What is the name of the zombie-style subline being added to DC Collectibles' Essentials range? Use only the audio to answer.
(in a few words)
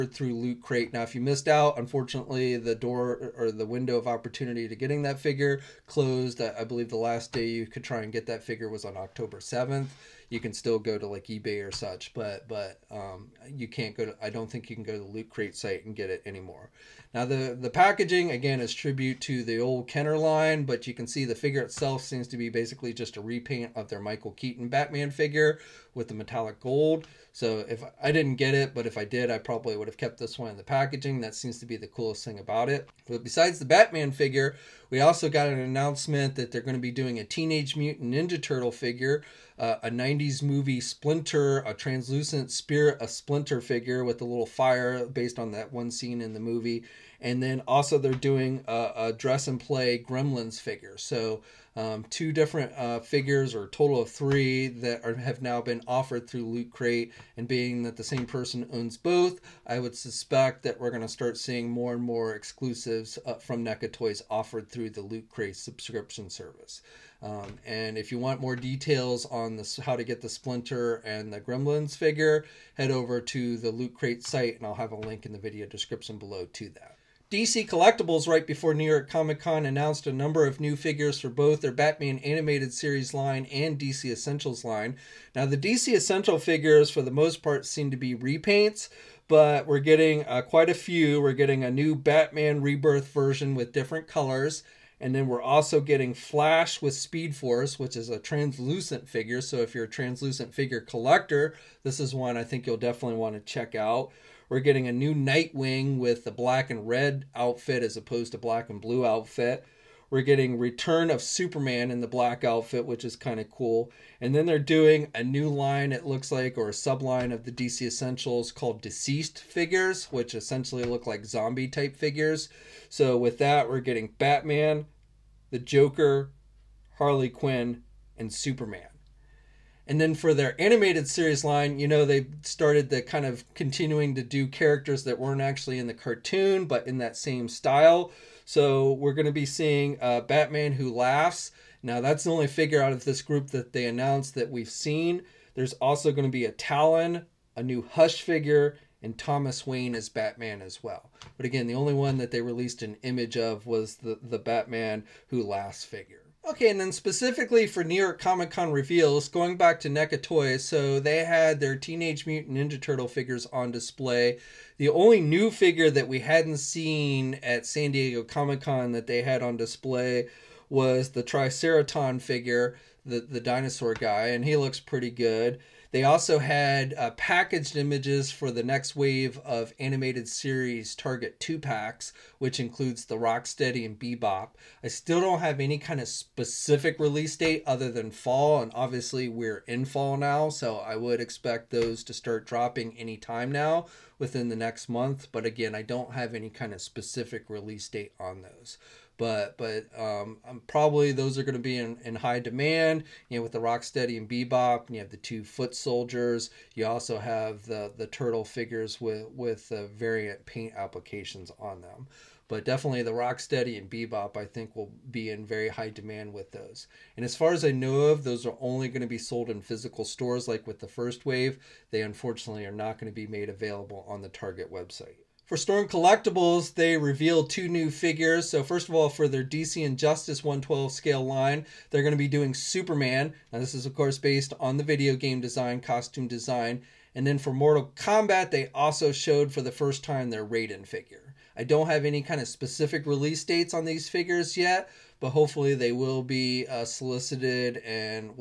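Deceased.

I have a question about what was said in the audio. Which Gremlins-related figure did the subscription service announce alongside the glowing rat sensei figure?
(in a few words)
dress and play Gremlins.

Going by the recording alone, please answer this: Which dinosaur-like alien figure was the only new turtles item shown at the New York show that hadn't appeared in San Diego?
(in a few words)
Triceraton.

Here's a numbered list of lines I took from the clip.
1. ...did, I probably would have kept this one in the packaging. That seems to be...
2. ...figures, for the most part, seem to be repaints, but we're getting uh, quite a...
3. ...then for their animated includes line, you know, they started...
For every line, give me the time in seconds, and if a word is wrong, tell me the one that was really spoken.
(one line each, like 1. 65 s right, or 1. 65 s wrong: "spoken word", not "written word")
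1. 29 s right
2. 86 s right
3. 129 s wrong: "series", not "includes".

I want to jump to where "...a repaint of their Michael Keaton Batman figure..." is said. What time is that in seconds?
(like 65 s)
23 s.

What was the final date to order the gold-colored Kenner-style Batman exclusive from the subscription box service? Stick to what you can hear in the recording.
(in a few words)
October 7.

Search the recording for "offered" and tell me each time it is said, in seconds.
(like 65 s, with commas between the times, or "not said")
55 s, 64 s.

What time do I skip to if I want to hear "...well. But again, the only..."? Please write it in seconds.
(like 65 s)
150 s.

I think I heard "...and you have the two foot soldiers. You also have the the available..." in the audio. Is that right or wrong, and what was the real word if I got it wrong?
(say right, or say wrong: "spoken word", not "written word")
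wrong: "turtle", not "available".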